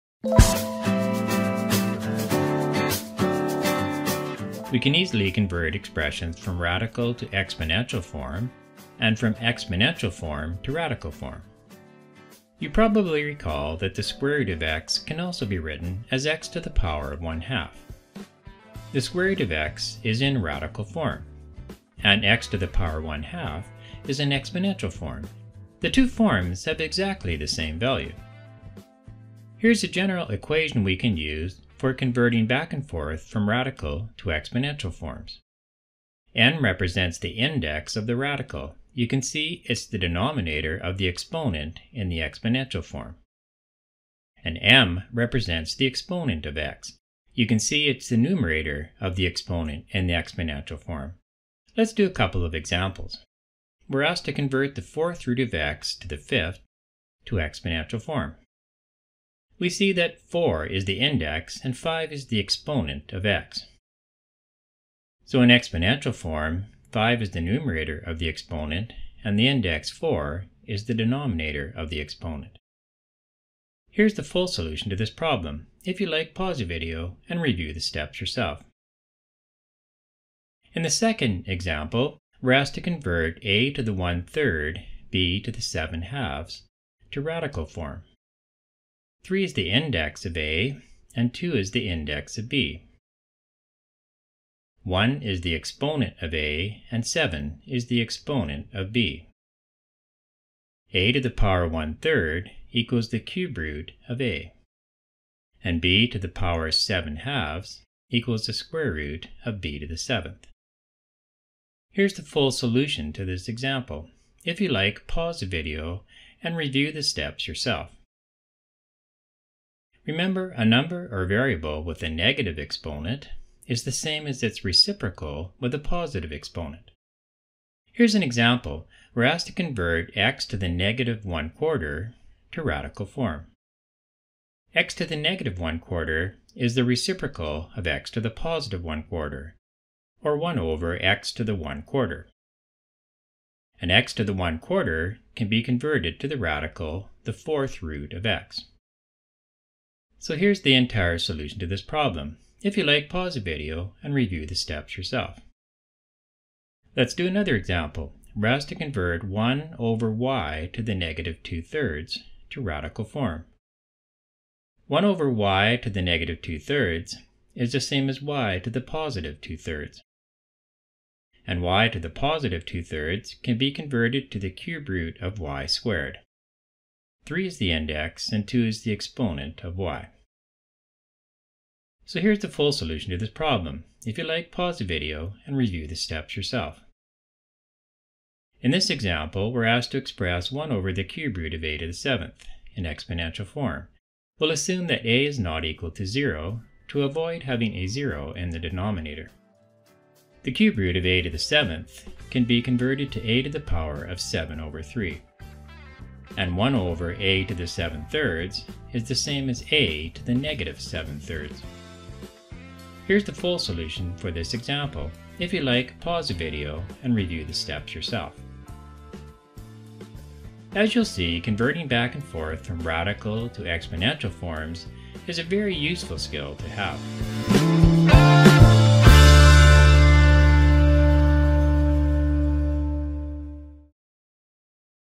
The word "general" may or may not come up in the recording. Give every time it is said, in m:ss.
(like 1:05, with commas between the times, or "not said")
0:29.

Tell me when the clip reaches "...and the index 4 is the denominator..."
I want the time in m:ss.
1:09.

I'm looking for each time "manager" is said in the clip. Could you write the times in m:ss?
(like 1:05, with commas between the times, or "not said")
not said.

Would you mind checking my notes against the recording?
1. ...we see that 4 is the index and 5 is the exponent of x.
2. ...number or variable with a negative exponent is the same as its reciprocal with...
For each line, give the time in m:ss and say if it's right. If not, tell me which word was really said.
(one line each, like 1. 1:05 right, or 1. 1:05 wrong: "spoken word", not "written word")
1. 0:59 right
2. 2:00 right.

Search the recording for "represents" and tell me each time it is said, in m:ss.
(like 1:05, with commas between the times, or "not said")
0:36, 0:45.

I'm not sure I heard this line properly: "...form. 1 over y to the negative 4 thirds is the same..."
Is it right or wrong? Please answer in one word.
wrong.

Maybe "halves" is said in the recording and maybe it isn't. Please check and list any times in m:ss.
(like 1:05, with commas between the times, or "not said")
1:26, 1:47.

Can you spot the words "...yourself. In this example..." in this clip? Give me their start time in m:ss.
3:06.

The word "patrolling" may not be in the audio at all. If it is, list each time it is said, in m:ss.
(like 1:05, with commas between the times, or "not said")
not said.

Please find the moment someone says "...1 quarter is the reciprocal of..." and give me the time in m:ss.
2:15.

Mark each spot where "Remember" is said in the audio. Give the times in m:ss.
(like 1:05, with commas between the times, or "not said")
2:00.